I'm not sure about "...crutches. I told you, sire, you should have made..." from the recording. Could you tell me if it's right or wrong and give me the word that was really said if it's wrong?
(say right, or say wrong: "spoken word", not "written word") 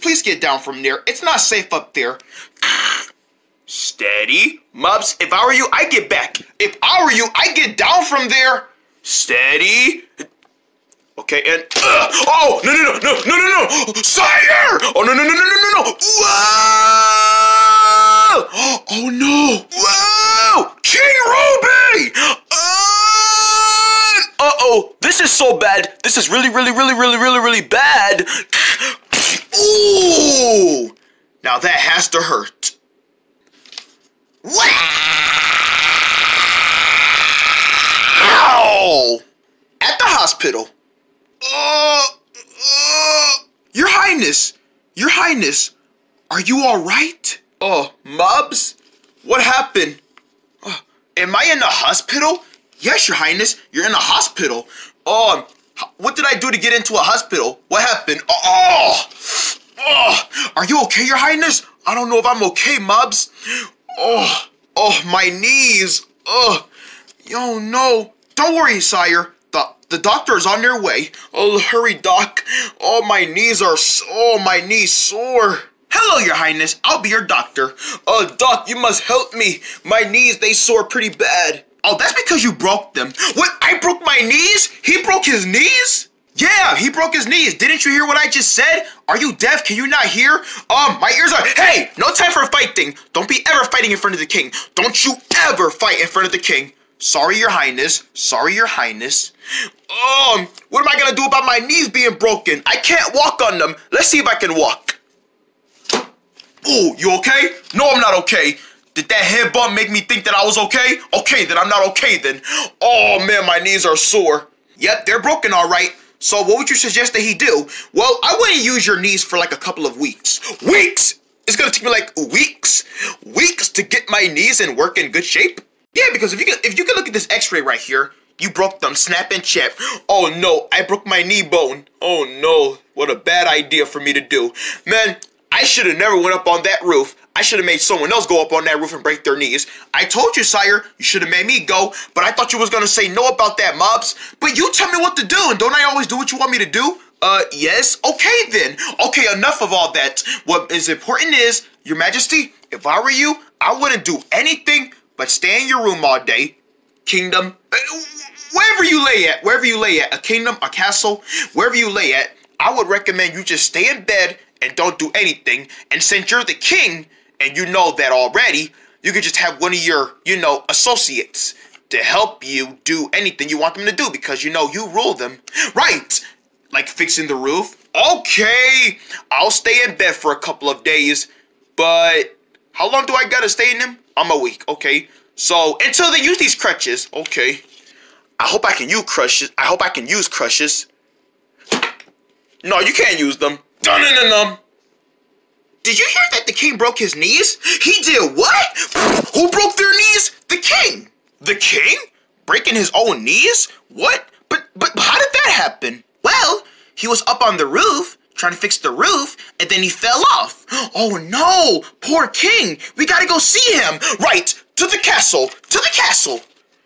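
wrong: "knees", not "crutches".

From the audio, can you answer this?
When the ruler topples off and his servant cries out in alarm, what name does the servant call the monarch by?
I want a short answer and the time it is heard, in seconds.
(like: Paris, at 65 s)
King Ruby, at 20 s.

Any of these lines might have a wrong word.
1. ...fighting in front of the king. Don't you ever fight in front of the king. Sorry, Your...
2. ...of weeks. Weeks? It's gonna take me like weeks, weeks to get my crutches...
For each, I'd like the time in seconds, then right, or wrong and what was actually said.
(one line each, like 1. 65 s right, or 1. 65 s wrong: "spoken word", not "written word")
1. 93 s right
2. 119 s wrong: "knees", not "crutches".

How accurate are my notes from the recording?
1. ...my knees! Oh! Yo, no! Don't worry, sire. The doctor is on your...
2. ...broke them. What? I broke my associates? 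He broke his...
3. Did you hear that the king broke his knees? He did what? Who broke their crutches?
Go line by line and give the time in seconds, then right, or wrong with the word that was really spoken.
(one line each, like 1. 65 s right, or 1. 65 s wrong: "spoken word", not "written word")
1. 65 s right
2. 82 s wrong: "knees", not "associates"
3. 195 s wrong: "knees", not "crutches".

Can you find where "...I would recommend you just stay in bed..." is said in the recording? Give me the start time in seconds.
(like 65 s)
162 s.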